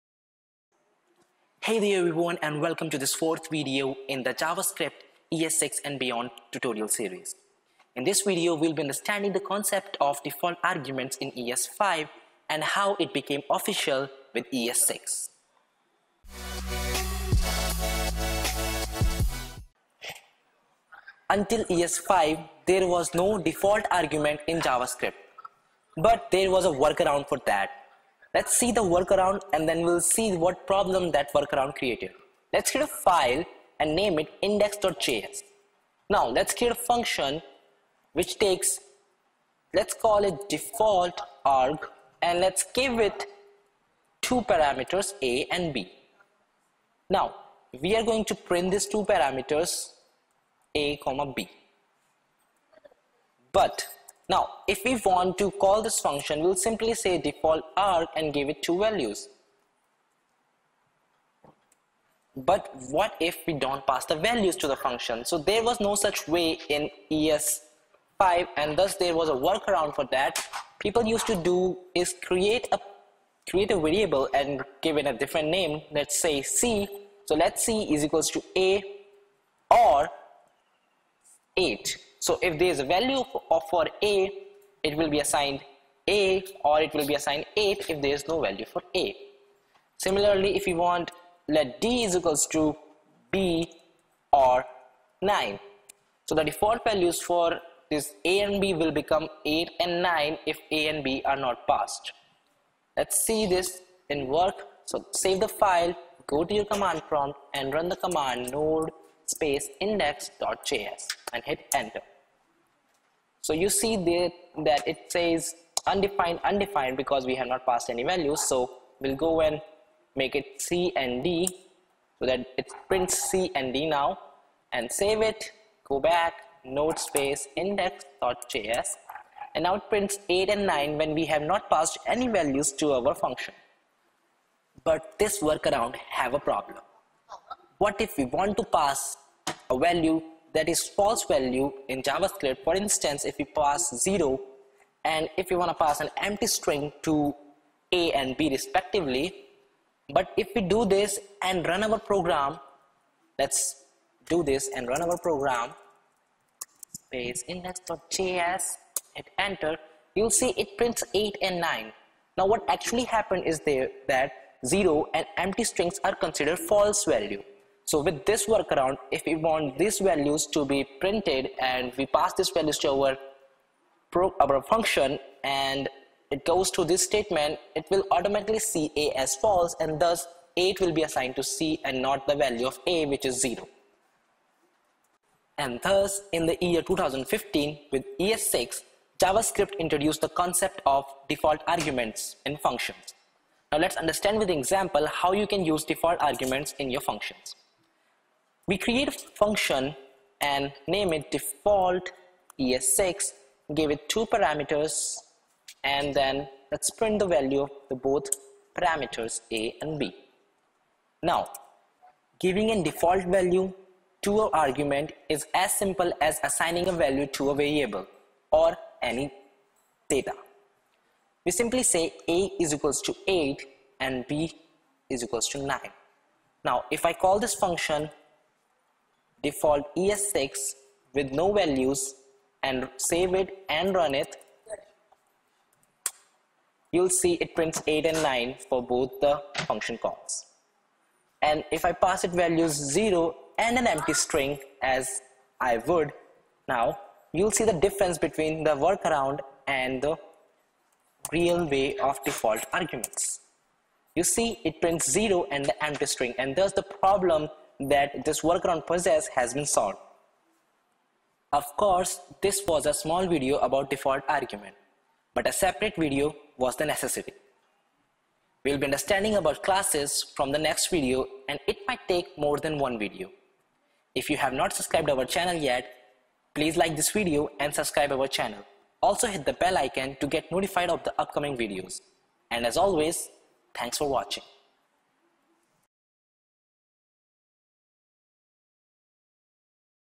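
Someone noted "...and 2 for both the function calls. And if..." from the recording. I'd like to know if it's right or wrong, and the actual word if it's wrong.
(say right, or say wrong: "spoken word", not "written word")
wrong: "9", not "2".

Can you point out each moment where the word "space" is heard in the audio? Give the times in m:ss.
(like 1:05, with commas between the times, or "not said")
1:49, 2:06, 2:36.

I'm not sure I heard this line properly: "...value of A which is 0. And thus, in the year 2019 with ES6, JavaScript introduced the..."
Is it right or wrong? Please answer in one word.
wrong.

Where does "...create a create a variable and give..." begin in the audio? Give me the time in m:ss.
1:12.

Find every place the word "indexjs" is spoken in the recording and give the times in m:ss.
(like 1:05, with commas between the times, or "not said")
0:34, 1:49, 2:07, 2:37.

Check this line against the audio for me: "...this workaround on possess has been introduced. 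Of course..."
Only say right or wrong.
wrong.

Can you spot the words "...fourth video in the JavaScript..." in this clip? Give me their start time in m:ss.
0:03.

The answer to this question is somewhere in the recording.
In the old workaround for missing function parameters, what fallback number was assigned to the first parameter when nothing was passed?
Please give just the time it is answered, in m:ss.
1:18.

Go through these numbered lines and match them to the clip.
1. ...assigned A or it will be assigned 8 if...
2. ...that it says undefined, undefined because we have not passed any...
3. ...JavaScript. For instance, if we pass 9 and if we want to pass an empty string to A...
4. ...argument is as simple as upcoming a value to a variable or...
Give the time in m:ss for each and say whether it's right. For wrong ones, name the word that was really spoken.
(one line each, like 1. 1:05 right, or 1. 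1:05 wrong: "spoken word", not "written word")
1. 1:25 right
2. 1:54 right
3. 2:22 wrong: "0", not "9"
4. 3:34 wrong: "assigning", not "upcoming".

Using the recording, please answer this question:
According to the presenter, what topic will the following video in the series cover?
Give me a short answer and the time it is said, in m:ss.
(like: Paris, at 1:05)
classes, at 4:29.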